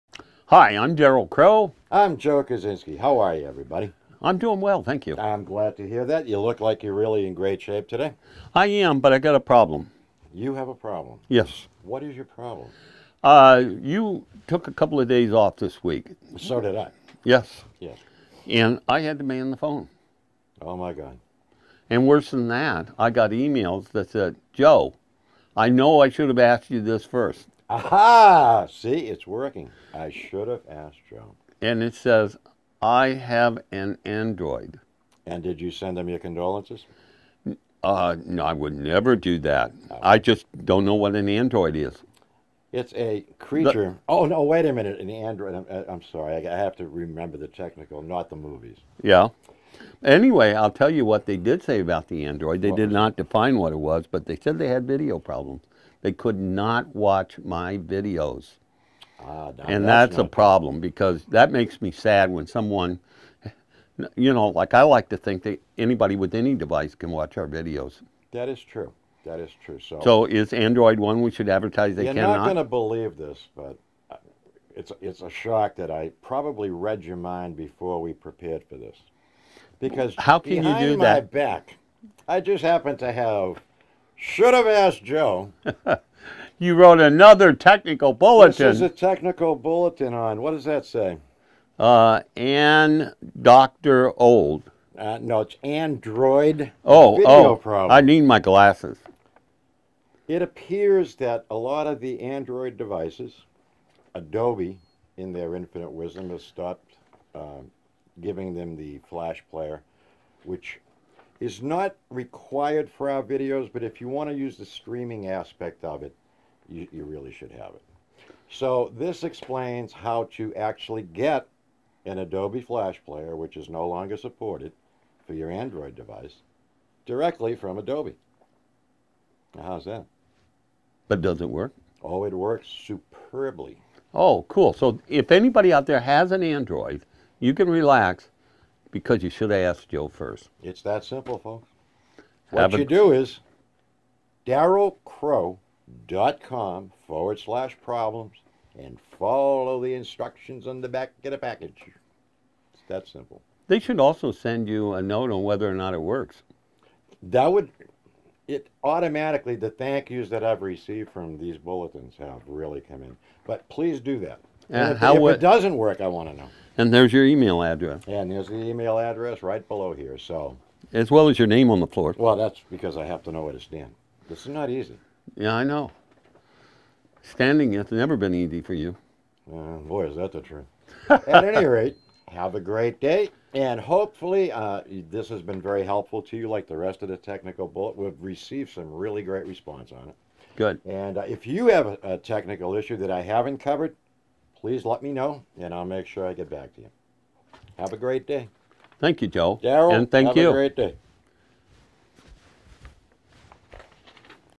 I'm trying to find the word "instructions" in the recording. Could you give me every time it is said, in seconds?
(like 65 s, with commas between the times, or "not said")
149 s.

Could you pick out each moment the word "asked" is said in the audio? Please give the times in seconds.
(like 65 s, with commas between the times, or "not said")
26 s, 30 s, 84 s.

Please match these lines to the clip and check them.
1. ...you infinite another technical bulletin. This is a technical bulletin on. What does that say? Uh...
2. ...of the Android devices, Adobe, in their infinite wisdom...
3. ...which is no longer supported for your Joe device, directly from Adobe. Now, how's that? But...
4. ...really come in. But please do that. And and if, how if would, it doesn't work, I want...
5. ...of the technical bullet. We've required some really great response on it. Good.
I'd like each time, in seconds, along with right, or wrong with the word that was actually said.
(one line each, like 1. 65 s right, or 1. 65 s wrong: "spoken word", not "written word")
1. 86 s wrong: "wrote", not "infinite"
2. 101 s right
3. 123 s wrong: "Android", not "Joe"
4. 162 s right
5. 187 s wrong: "received", not "required".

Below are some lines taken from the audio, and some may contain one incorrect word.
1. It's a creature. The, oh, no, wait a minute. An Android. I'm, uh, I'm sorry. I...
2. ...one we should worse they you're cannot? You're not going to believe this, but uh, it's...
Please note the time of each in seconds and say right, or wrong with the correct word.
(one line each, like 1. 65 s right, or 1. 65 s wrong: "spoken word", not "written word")
1. 42 s right
2. 70 s wrong: "advertise", not "worse".